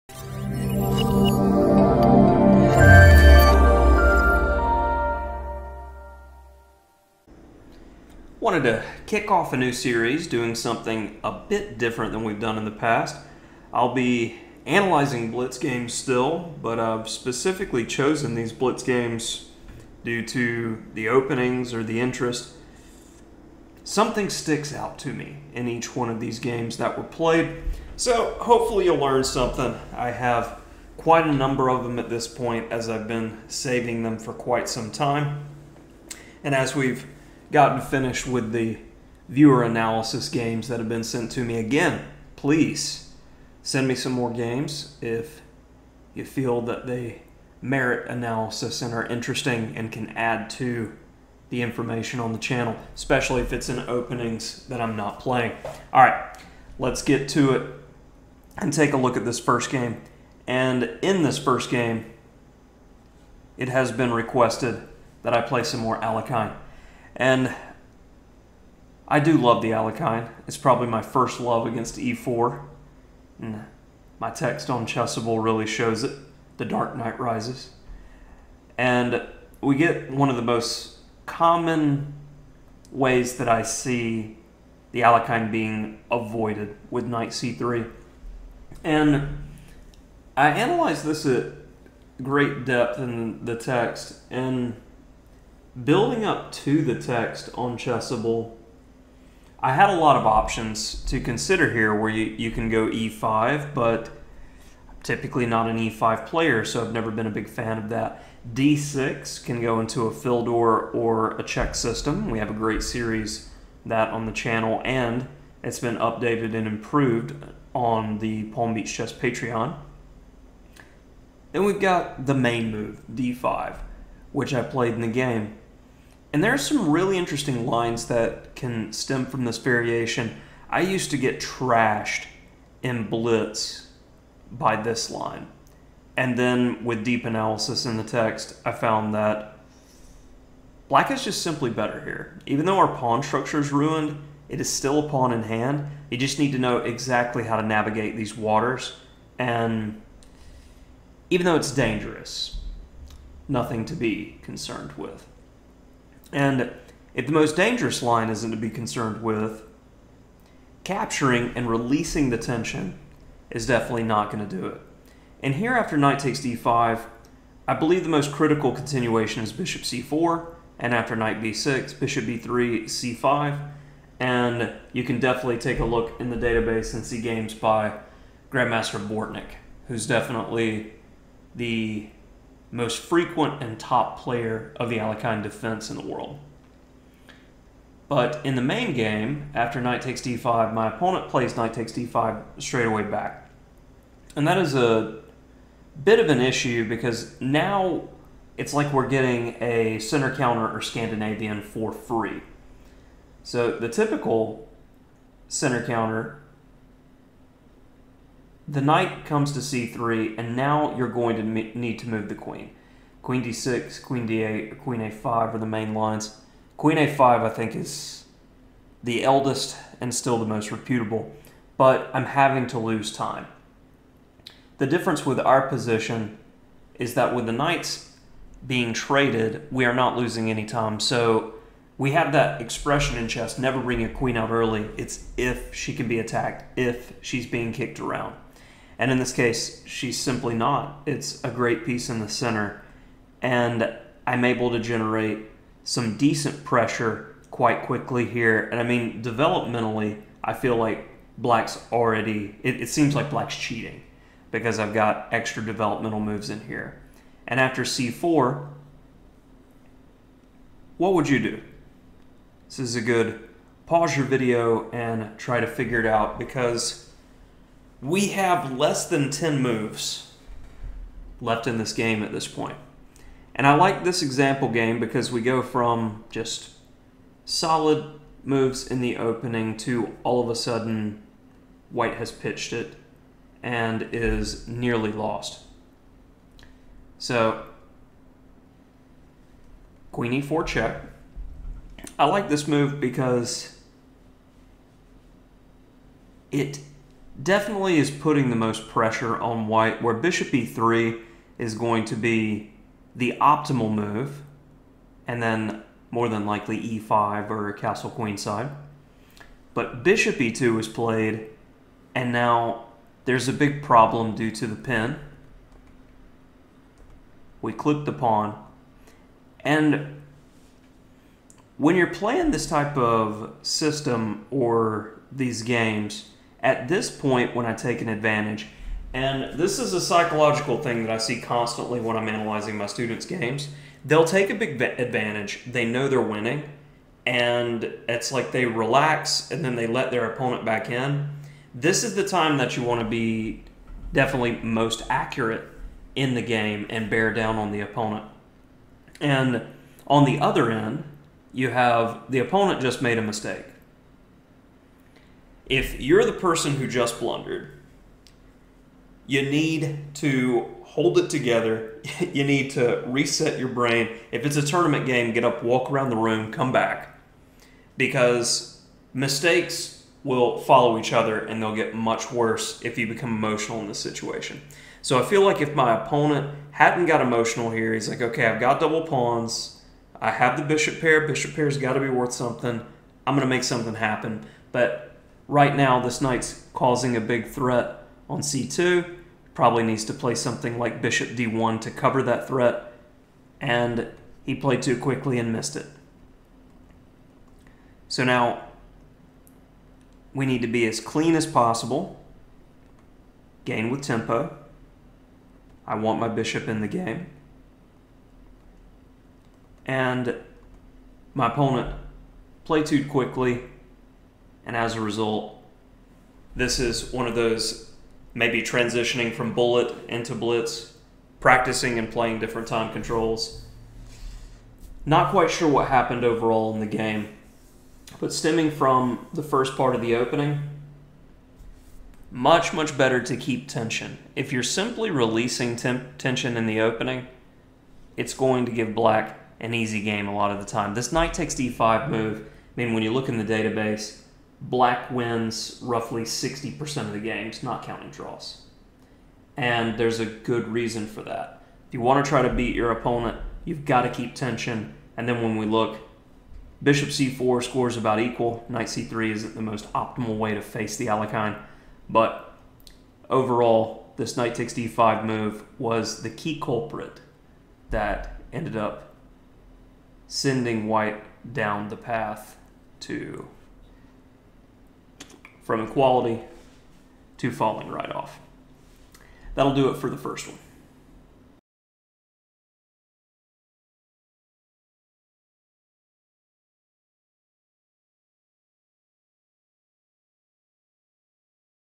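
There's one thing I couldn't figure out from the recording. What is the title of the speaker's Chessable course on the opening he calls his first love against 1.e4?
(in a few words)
The Dark Knight Rises.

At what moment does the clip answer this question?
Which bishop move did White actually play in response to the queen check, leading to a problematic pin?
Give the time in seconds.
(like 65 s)
310 s.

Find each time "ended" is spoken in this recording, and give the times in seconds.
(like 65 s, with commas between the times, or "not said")
468 s.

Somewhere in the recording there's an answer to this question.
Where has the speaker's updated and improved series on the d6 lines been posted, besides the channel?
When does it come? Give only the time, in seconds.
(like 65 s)
118 s.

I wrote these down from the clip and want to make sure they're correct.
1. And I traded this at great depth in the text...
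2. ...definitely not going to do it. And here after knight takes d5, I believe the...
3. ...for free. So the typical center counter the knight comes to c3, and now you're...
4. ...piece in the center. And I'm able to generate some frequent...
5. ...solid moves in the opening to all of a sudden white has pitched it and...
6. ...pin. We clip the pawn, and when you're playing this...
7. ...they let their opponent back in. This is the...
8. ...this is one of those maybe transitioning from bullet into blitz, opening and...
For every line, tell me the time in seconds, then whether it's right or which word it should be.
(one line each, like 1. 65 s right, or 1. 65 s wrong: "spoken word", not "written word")
1. 88 s wrong: "analyzed", not "traded"
2. 163 s right
3. 201 s right
4. 241 s wrong: "decent", not "frequent"
5. 277 s right
6. 314 s right
7. 339 s right
8. 416 s wrong: "practicing", not "opening".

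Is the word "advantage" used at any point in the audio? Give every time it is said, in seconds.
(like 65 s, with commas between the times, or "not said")
328 s, 334 s.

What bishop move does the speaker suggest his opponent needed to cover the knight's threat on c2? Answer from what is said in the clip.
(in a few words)
Bishop d1.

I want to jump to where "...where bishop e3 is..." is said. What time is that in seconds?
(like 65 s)
300 s.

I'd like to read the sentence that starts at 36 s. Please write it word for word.
And as we've gotten finished with the viewer analysis games that have been sent to me.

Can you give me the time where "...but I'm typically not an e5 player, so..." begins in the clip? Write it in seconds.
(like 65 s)
103 s.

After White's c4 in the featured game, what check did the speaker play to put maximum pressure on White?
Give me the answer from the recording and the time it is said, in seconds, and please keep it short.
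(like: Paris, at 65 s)
Queen e4 check, at 290 s.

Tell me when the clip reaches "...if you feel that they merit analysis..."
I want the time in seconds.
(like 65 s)
45 s.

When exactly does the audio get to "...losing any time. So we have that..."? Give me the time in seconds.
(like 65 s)
230 s.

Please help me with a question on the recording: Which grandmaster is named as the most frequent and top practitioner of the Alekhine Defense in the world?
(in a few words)
Bortnyk.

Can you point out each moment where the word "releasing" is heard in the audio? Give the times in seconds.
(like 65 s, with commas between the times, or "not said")
161 s, 435 s.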